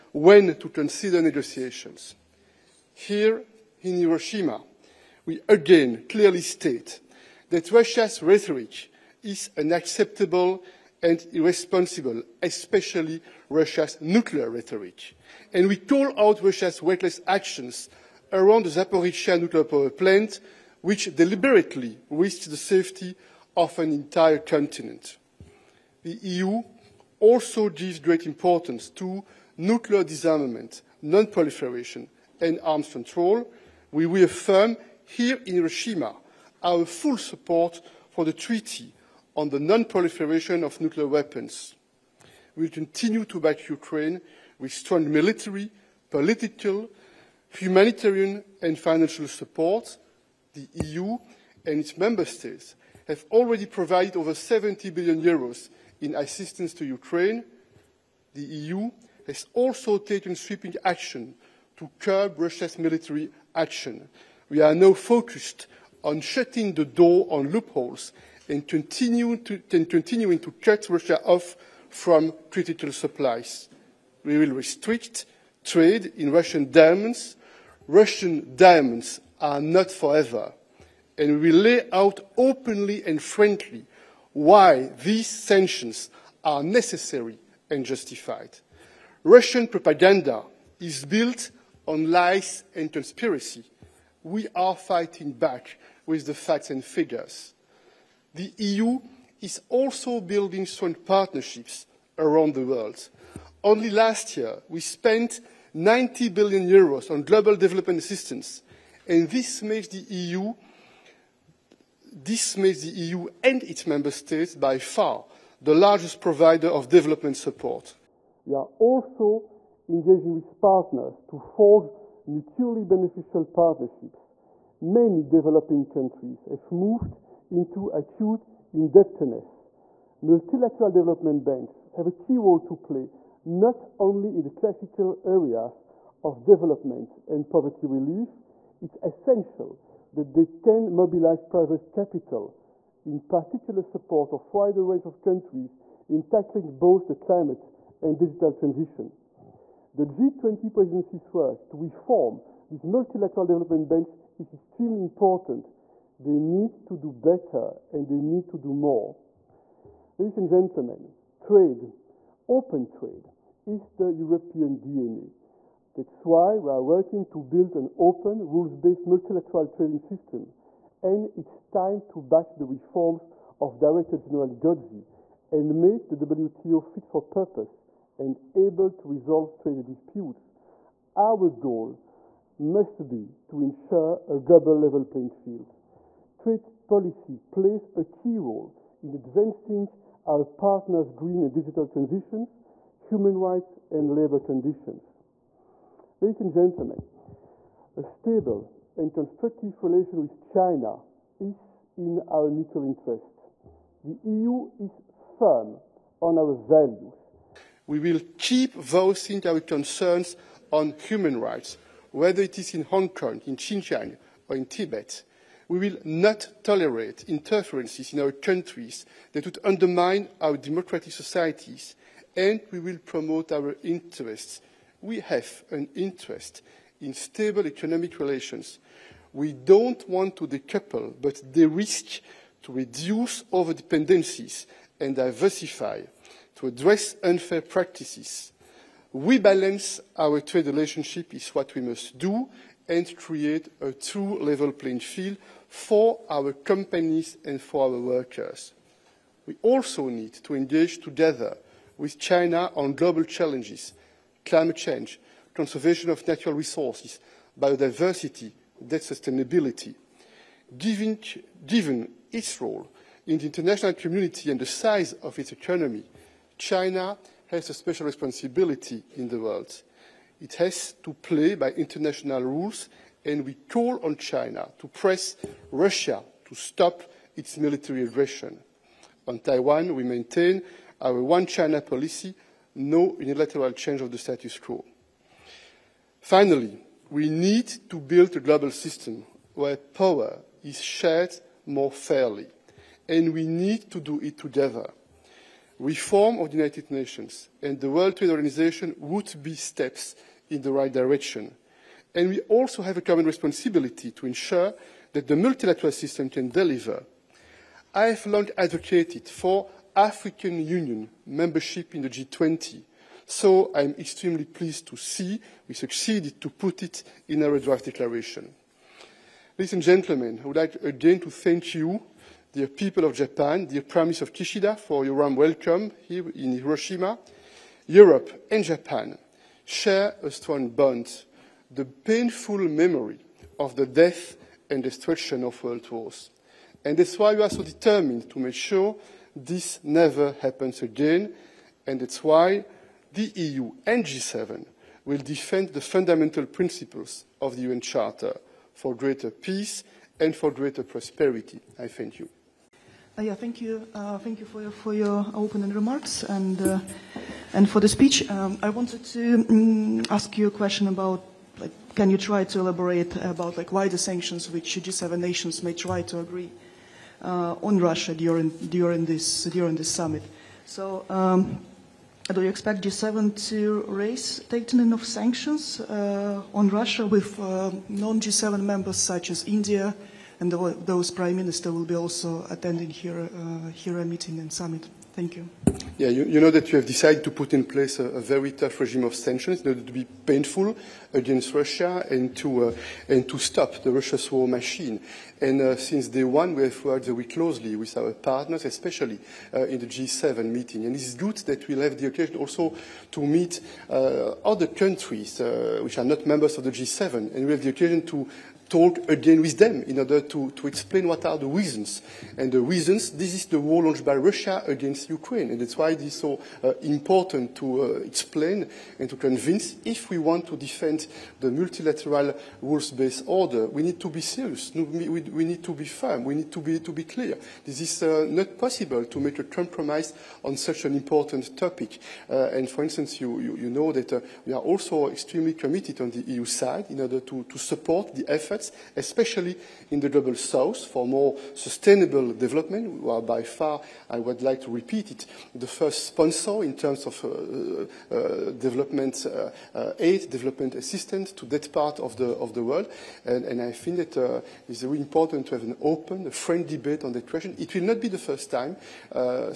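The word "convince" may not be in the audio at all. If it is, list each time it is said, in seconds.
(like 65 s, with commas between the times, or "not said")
419 s.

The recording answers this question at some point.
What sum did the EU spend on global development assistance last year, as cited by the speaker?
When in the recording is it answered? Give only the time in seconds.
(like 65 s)
105 s.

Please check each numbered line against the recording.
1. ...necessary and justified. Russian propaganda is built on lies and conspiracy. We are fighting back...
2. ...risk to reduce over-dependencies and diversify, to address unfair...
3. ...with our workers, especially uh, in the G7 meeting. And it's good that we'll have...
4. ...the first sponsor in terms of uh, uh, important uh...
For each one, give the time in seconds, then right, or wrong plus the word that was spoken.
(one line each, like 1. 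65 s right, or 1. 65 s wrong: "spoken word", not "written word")
1. 86 s right
2. 231 s right
3. 397 s wrong: "partners", not "workers"
4. 445 s wrong: "development", not "important".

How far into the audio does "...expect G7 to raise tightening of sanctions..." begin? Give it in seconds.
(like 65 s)
372 s.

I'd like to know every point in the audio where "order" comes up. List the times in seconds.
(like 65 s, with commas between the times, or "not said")
389 s, 409 s, 423 s, 437 s.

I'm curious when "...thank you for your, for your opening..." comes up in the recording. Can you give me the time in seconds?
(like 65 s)
354 s.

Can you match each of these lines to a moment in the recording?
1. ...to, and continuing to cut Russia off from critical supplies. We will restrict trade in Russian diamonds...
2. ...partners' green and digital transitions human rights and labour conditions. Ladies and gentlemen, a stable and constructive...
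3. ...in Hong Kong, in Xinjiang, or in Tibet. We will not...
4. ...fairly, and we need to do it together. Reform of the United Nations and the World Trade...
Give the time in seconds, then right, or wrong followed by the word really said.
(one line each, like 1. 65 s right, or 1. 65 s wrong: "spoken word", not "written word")
1. 69 s right
2. 190 s right
3. 212 s right
4. 291 s right.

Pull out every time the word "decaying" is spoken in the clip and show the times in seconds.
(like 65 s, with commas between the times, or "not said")
not said.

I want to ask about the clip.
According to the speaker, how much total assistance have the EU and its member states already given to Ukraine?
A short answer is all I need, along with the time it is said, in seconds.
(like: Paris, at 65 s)
over 70 billion euros, at 54 s.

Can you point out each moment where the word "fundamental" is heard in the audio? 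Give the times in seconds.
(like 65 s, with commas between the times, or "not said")
345 s.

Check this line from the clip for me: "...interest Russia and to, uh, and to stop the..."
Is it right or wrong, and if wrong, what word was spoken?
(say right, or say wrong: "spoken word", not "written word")
wrong: "against", not "interest".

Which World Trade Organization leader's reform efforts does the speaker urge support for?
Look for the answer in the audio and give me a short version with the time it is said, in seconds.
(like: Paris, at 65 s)
Director General Giorgi, at 173 s.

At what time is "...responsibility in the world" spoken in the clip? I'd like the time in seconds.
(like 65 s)
268 s.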